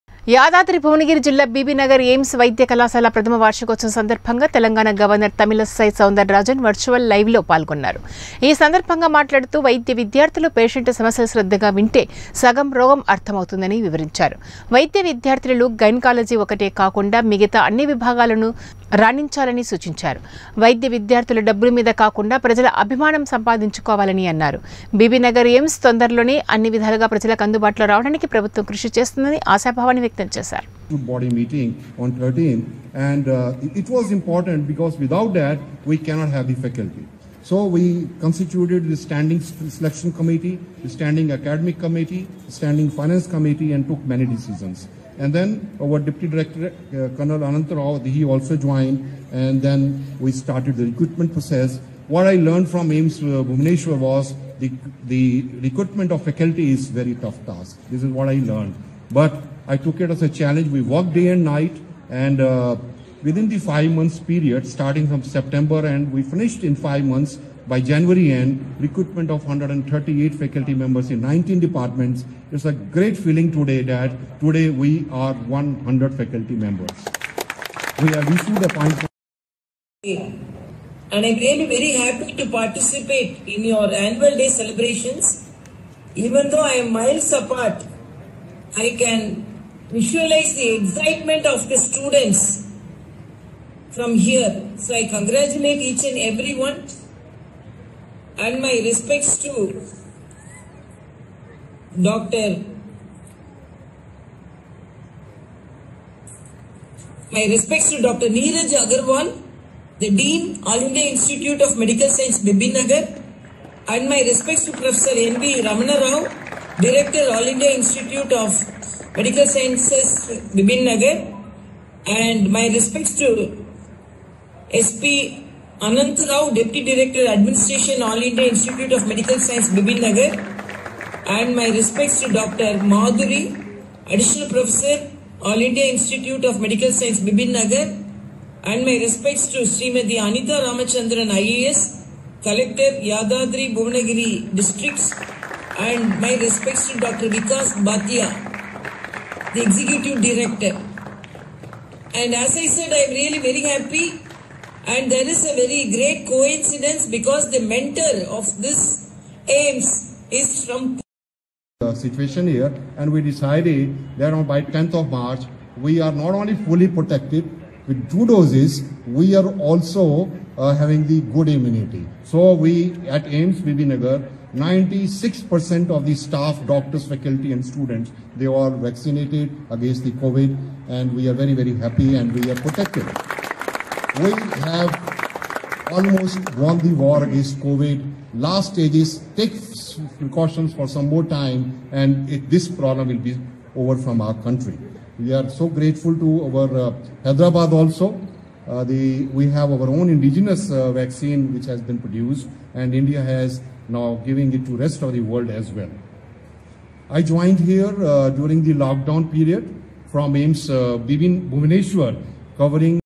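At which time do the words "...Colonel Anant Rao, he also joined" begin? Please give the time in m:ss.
0:47.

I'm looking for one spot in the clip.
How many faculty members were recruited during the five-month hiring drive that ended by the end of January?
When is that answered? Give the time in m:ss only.
1:09.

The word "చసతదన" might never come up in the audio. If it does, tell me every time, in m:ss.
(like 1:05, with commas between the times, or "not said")
0:28.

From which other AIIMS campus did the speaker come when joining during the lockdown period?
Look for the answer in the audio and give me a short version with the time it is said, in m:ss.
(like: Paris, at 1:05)
Bhubaneswar, at 3:31.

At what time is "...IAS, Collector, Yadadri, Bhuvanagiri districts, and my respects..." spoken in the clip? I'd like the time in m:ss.
2:21.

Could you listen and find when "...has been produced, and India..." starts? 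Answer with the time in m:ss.
3:21.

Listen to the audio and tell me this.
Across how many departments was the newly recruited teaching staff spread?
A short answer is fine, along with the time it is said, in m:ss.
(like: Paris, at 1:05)
19, at 1:11.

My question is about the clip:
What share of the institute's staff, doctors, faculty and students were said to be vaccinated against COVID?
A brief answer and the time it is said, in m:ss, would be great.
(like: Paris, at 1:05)
96%, at 2:54.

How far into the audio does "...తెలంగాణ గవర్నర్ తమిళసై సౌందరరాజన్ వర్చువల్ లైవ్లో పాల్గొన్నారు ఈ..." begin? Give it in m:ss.
0:04.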